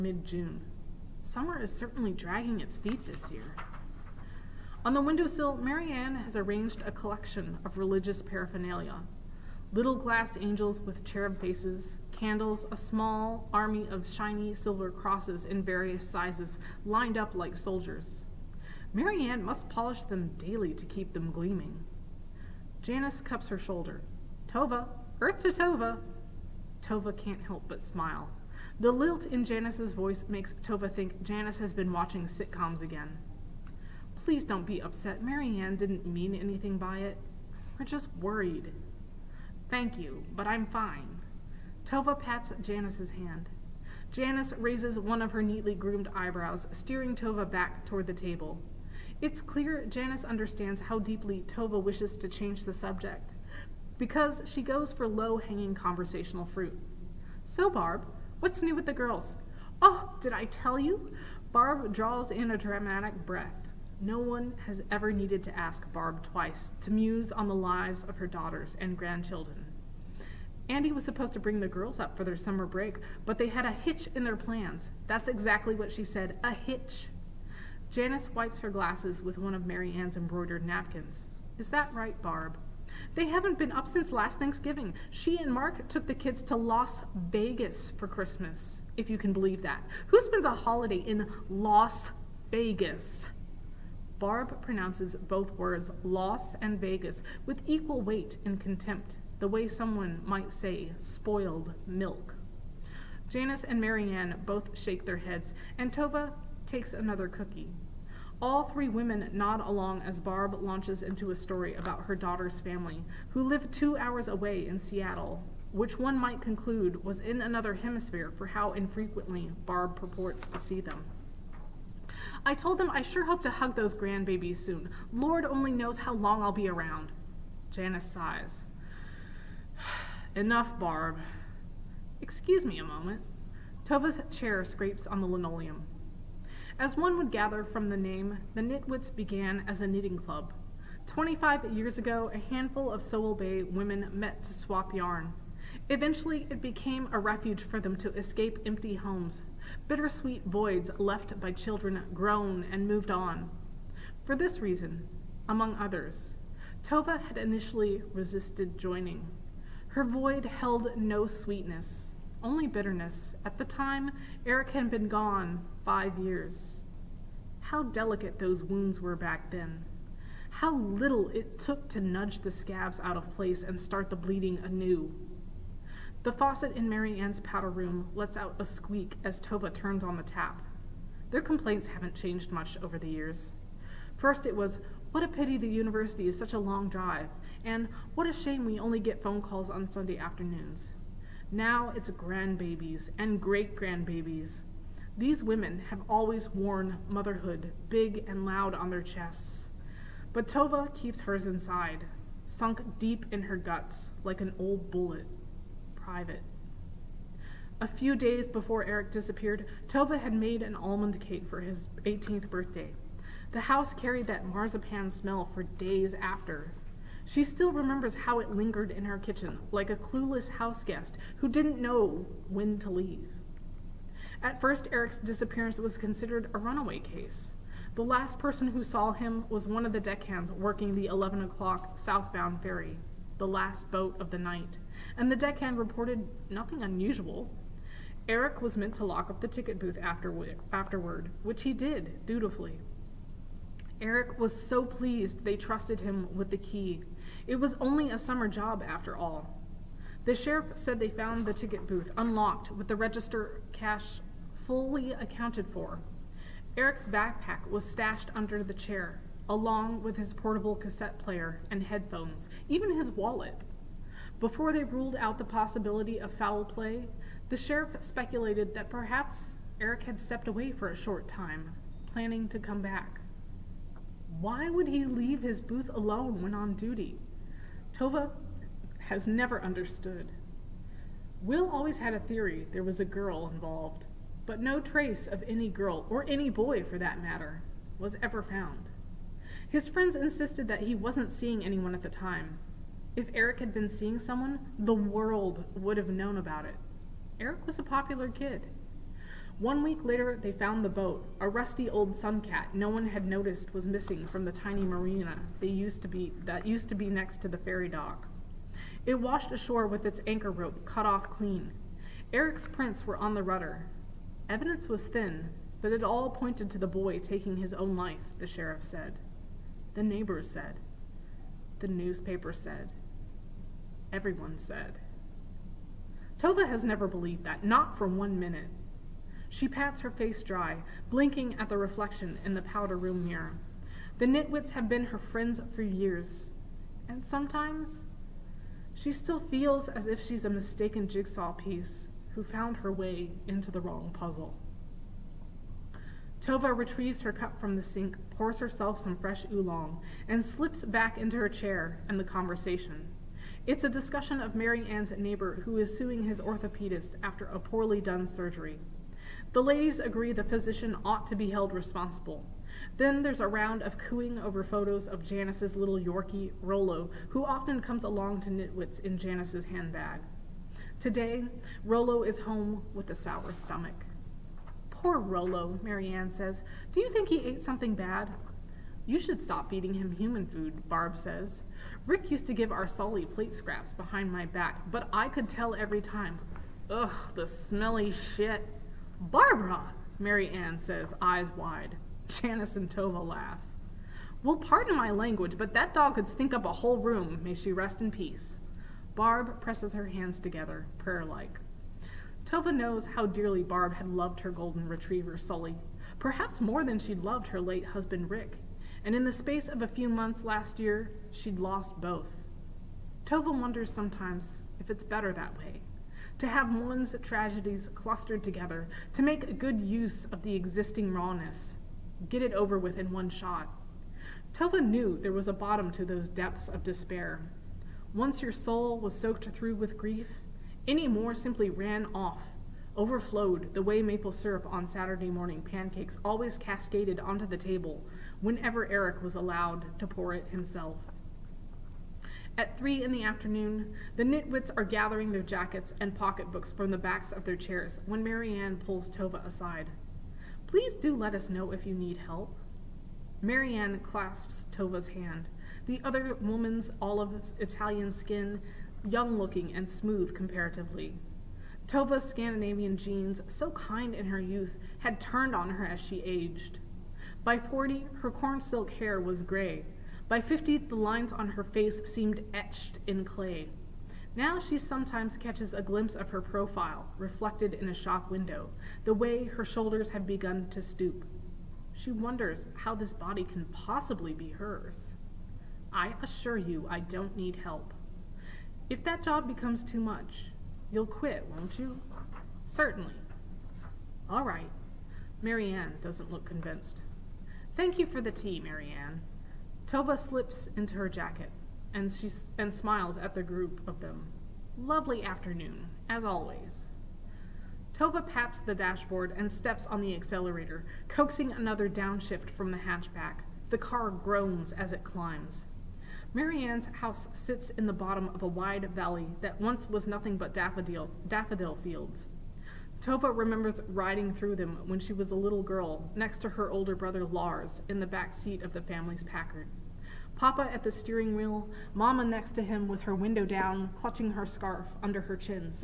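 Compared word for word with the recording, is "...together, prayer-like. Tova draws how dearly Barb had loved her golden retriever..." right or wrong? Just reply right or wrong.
wrong.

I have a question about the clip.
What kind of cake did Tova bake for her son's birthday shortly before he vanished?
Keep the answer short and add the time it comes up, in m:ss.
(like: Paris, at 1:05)
Almond cake, at 3:30.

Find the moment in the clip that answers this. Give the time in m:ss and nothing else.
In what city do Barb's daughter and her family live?
1:54.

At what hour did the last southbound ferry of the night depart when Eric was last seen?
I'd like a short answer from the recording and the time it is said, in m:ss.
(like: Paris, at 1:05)
11 o'clock, at 3:51.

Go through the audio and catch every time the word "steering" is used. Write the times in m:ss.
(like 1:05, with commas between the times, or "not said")
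0:46, 8:50.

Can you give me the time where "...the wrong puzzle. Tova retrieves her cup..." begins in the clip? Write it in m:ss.
5:43.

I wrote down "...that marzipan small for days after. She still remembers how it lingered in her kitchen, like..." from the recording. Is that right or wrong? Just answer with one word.
wrong.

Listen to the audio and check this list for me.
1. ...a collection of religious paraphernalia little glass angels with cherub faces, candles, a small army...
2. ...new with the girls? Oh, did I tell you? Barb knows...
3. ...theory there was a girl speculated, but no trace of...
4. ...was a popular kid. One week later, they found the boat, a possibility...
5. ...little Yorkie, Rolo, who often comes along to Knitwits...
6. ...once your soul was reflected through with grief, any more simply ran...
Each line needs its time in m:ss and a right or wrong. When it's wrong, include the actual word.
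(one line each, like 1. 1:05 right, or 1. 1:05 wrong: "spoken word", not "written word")
1. 0:06 right
2. 0:58 wrong: "draws", not "knows"
3. 4:42 wrong: "involved", not "speculated"
4. 4:57 wrong: "rusty", not "possibility"
5. 6:05 right
6. 7:08 wrong: "soaked", not "reflected".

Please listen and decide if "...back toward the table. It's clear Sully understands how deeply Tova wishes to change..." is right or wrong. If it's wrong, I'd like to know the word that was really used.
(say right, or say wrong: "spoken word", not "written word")
wrong: "Janice", not "Sully".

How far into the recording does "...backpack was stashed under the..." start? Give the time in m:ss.
4:17.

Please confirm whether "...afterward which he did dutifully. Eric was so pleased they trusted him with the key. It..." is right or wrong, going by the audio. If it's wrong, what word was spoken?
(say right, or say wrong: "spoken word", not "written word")
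right.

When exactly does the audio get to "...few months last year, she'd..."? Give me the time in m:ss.
6:49.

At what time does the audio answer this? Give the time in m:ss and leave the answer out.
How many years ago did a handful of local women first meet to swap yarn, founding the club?
2:21.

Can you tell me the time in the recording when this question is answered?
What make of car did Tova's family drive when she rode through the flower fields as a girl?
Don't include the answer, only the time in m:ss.
8:49.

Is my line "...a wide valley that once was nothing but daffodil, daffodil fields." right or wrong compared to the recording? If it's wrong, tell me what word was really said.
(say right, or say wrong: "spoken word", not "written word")
right.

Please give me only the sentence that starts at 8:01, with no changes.
She wonders how this body can possibly be hers.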